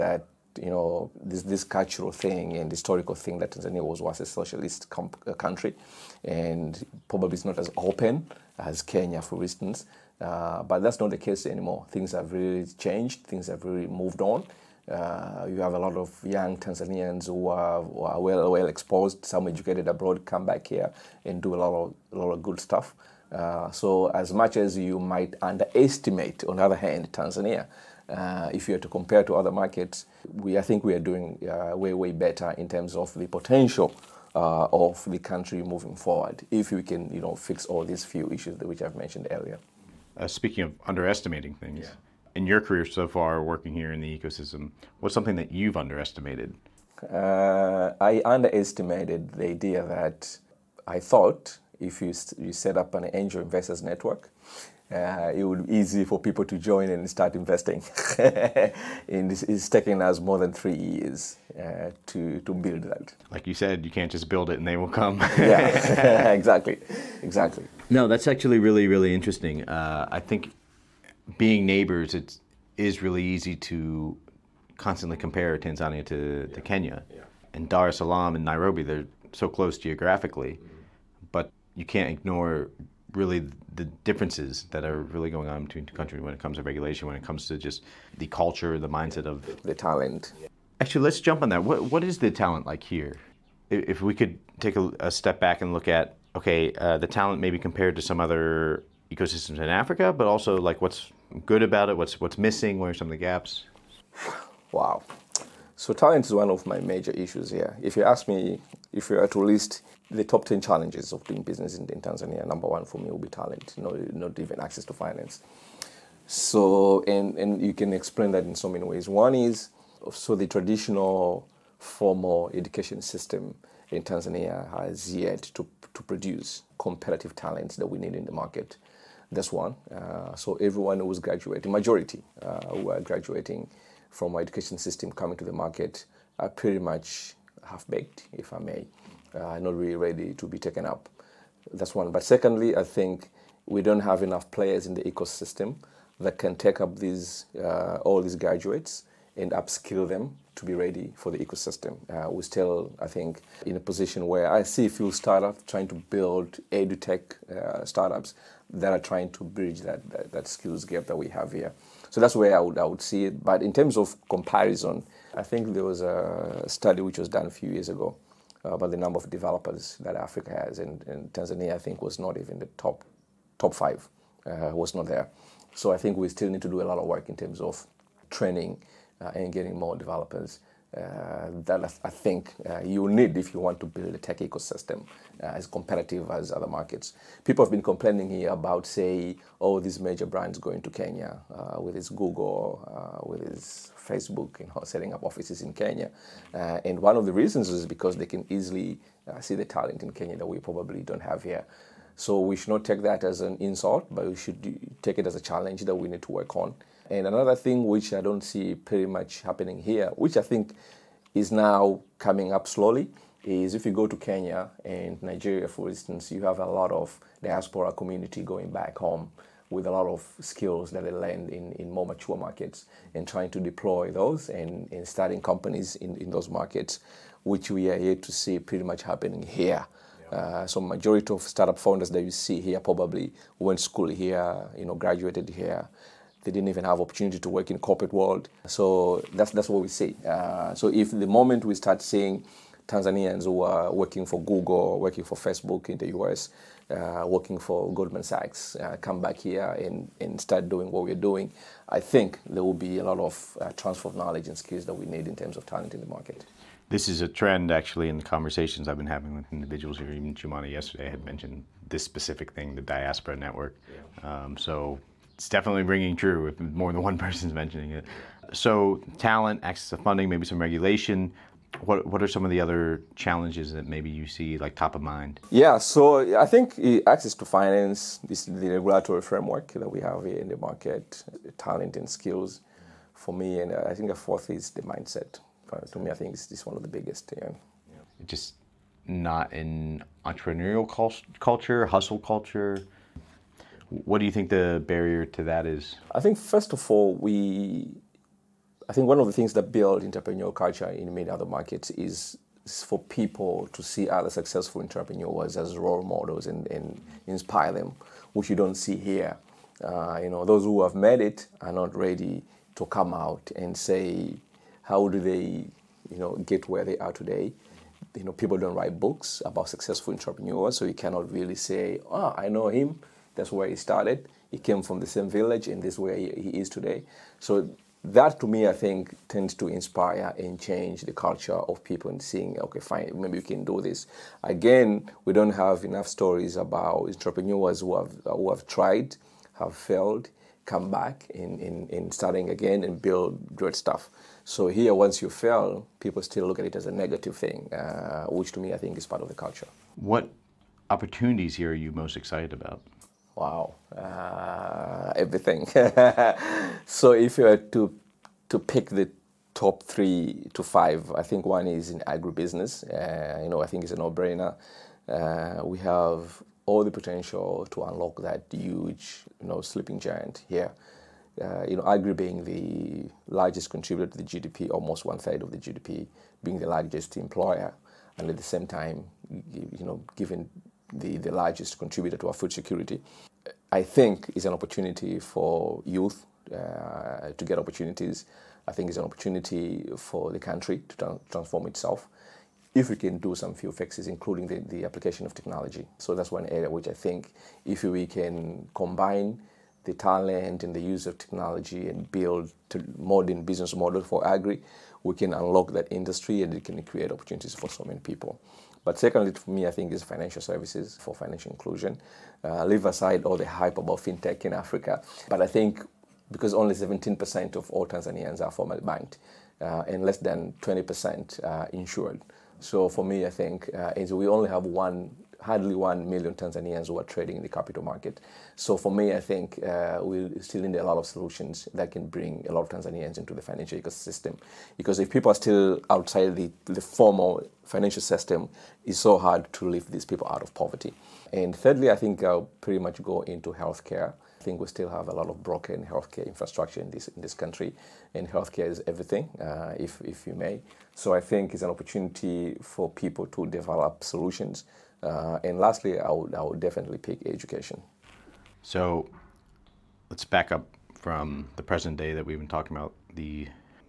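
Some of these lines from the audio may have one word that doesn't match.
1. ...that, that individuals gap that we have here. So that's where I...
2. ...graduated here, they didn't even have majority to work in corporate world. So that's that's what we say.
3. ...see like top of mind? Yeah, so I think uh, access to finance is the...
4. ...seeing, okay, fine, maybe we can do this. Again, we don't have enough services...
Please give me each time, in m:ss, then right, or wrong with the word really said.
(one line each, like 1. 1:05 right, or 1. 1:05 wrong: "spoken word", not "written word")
1. 2:40 wrong: "skills", not "individuals"
2. 3:54 wrong: "opportunity", not "majority"
3. 4:34 right
4. 5:32 wrong: "stories", not "services".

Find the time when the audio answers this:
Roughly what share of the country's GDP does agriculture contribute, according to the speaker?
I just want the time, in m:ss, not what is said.
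6:14.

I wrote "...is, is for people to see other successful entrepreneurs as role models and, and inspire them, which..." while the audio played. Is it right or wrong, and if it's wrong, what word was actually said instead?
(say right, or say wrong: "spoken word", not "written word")
right.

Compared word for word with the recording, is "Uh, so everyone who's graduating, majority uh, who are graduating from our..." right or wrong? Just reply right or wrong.
right.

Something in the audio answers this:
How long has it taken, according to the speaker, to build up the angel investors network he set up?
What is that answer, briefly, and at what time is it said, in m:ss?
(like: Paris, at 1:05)
More than 3 years, at 1:00.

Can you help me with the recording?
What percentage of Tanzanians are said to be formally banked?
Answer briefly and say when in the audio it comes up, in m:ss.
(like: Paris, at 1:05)
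17%, at 6:56.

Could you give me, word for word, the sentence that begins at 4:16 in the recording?
This is a trend, actually, in the conversations I've been having with individuals here.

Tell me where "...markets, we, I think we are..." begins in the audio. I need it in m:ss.
0:29.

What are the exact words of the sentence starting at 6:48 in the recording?
But secondly, for me, I think is financial services for financial inclusion.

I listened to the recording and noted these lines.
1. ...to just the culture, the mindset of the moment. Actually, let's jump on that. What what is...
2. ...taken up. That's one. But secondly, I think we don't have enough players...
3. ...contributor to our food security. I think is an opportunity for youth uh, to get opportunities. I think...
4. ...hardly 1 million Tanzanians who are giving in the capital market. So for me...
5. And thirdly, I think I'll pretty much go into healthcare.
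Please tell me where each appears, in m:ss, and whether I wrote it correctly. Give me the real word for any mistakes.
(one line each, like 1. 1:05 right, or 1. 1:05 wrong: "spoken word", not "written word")
1. 1:27 wrong: "talent", not "moment"
2. 2:20 right
3. 6:21 right
4. 7:05 wrong: "trading", not "giving"
5. 7:21 right.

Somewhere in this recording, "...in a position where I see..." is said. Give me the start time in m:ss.
2:33.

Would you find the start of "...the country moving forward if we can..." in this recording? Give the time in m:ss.
0:35.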